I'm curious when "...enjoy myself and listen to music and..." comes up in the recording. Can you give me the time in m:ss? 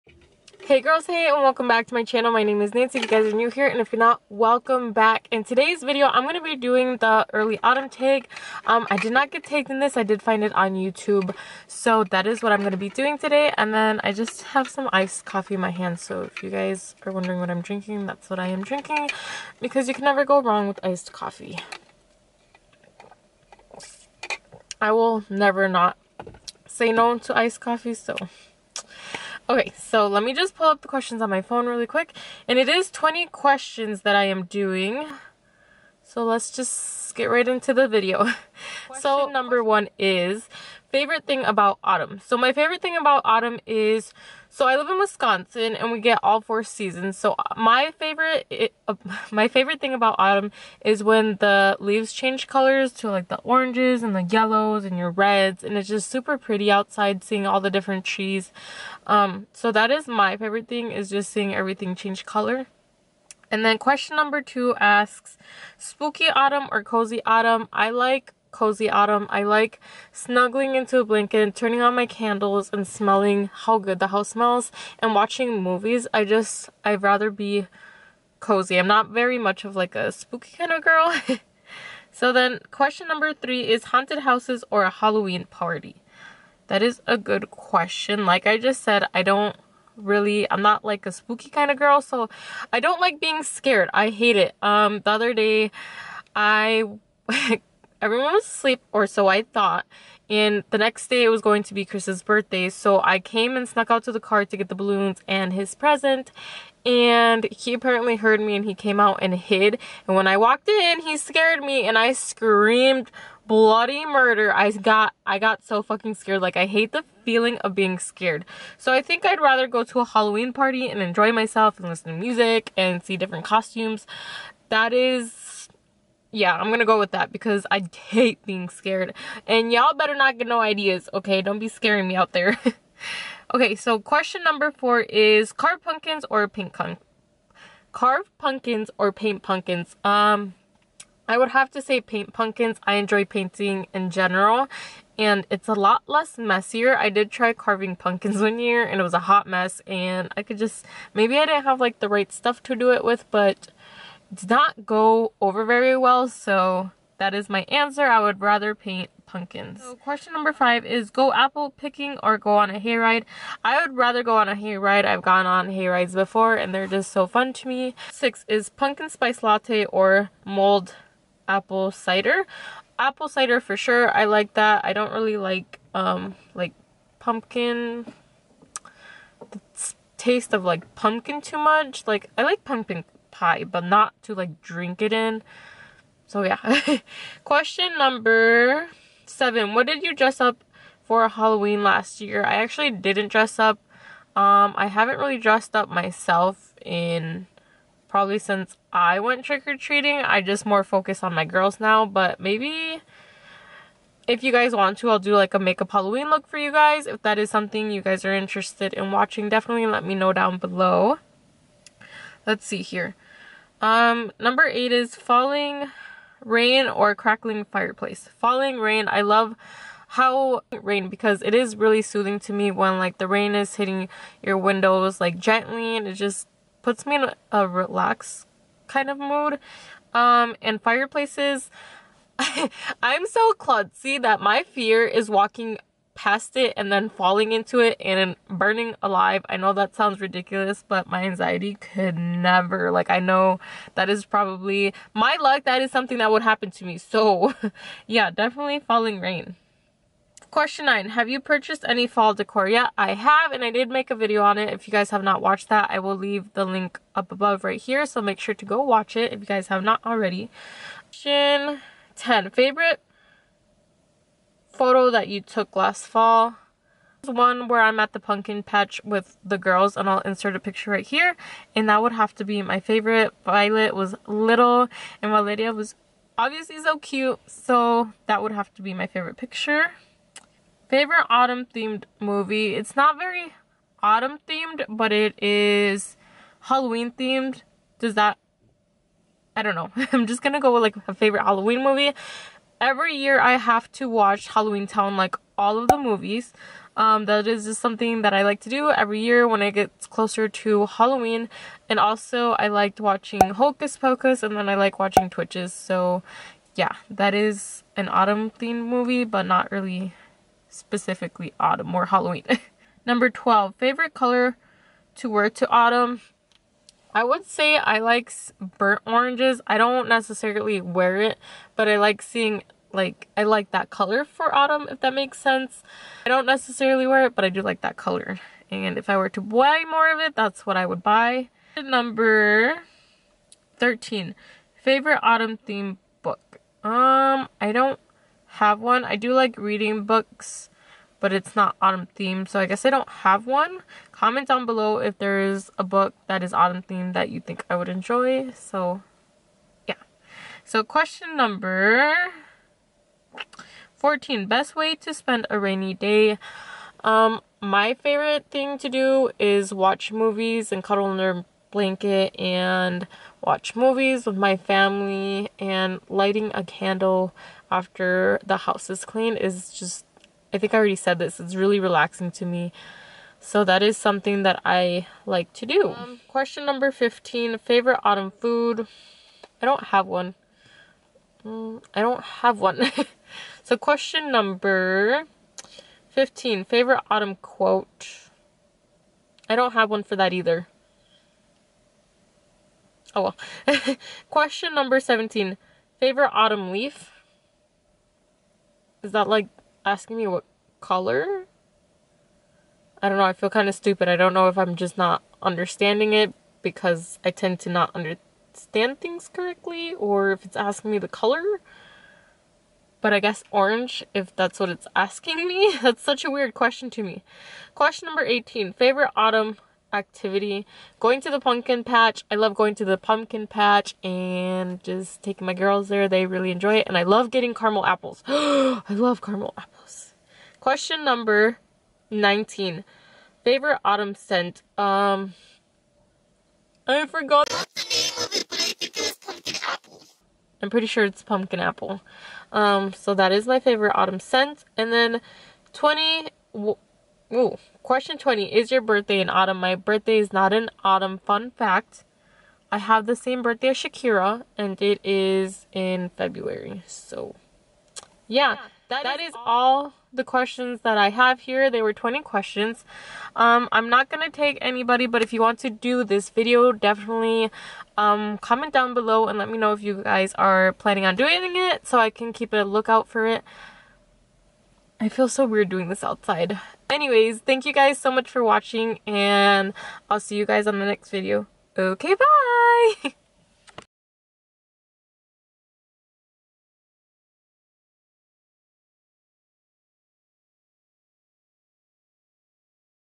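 2:01.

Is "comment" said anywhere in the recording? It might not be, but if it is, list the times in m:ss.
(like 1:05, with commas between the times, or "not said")
5:44, 7:48.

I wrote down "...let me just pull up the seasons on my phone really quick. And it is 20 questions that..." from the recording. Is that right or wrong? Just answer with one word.
wrong.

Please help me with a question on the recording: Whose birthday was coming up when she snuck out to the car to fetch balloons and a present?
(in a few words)
Chris.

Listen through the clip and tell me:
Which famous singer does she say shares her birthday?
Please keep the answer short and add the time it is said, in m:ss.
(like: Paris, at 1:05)
Shakira, at 7:33.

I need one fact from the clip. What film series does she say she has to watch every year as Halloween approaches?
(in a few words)
Halloween Town.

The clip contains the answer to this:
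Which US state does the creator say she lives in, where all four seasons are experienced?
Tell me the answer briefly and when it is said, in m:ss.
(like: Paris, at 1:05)
Wisconsin, at 0:44.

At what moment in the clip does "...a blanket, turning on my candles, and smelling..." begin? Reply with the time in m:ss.
1:10.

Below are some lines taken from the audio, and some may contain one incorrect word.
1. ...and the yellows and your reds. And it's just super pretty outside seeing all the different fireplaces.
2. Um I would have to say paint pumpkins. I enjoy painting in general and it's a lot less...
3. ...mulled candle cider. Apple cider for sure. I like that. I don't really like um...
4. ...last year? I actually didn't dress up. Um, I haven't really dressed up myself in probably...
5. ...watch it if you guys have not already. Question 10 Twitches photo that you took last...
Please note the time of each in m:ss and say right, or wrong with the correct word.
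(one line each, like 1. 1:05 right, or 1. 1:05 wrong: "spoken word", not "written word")
1. 0:54 wrong: "trees", not "fireplaces"
2. 2:20 right
3. 2:50 wrong: "apple", not "candle"
4. 3:11 right
5. 4:18 wrong: "Favorite", not "Twitches".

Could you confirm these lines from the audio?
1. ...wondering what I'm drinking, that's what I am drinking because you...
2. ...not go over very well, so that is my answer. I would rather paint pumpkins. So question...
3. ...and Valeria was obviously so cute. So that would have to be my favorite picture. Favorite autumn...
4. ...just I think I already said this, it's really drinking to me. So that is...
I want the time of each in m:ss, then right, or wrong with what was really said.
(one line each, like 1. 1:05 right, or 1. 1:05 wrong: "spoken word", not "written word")
1. 0:17 right
2. 2:34 right
3. 4:35 right
4. 6:09 wrong: "relaxing", not "drinking".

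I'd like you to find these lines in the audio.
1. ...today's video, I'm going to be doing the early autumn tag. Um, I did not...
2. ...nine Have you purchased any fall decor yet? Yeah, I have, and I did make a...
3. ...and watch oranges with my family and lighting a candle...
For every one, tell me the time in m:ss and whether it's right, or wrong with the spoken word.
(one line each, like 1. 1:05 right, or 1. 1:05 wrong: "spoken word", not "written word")
1. 0:05 right
2. 4:10 right
3. 6:02 wrong: "movies", not "oranges".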